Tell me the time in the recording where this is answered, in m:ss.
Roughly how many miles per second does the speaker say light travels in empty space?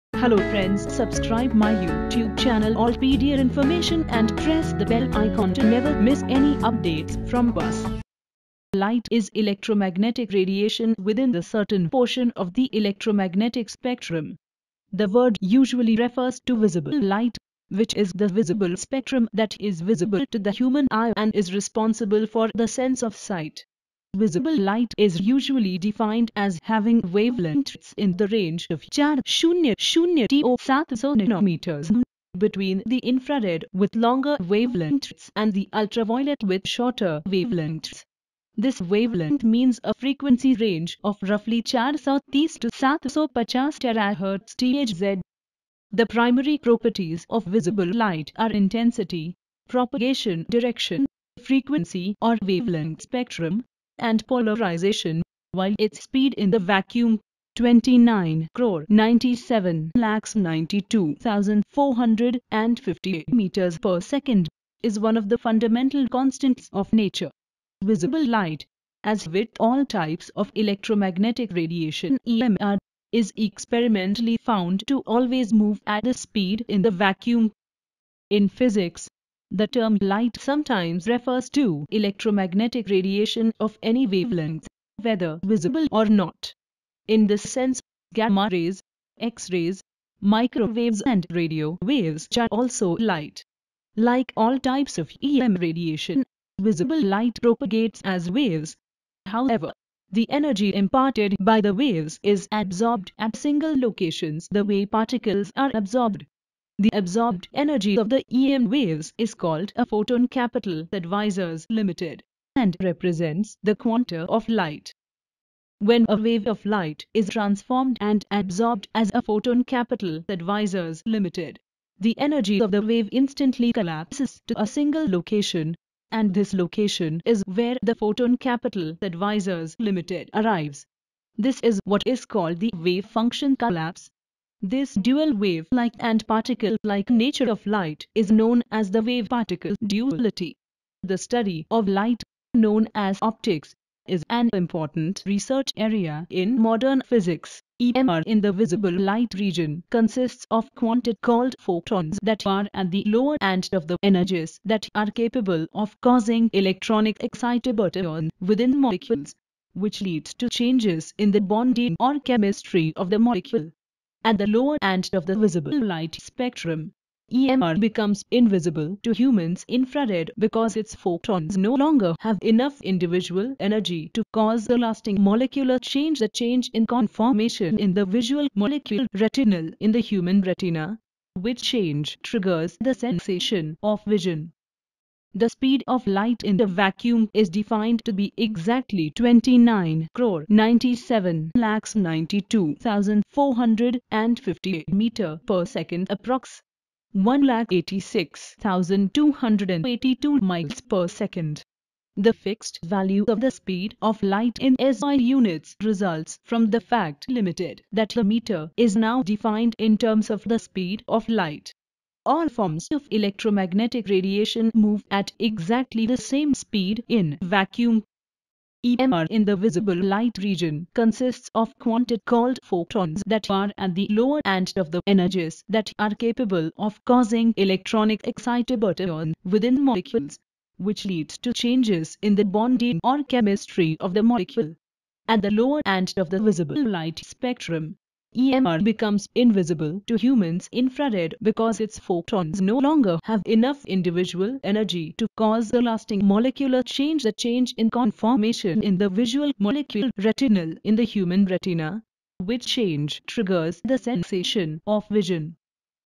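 3:17.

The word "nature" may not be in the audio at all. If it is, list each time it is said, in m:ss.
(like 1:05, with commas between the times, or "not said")
1:06, 2:17.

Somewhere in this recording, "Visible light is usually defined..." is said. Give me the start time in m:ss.
0:24.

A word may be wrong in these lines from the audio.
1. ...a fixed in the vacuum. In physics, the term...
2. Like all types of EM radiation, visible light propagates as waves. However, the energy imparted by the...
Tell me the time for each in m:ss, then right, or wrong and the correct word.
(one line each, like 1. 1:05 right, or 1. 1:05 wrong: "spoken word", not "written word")
1. 1:16 wrong: "speed", not "fixed"
2. 1:33 right.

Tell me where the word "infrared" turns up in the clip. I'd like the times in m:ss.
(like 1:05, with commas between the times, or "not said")
0:32, 2:49, 4:00.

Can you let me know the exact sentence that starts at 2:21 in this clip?
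The study of light, known as optics, is an important research area in modern physics.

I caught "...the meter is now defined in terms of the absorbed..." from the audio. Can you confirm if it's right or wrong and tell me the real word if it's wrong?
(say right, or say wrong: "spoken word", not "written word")
wrong: "speed", not "absorbed".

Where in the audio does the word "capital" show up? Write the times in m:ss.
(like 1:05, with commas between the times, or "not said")
1:50, 1:59, 2:08.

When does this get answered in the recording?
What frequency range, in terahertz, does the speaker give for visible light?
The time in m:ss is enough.
0:41.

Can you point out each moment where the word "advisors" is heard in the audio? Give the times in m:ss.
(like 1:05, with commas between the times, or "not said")
1:50, 2:00, 2:09.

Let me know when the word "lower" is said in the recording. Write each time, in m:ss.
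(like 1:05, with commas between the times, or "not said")
2:33, 2:44, 3:44, 3:55.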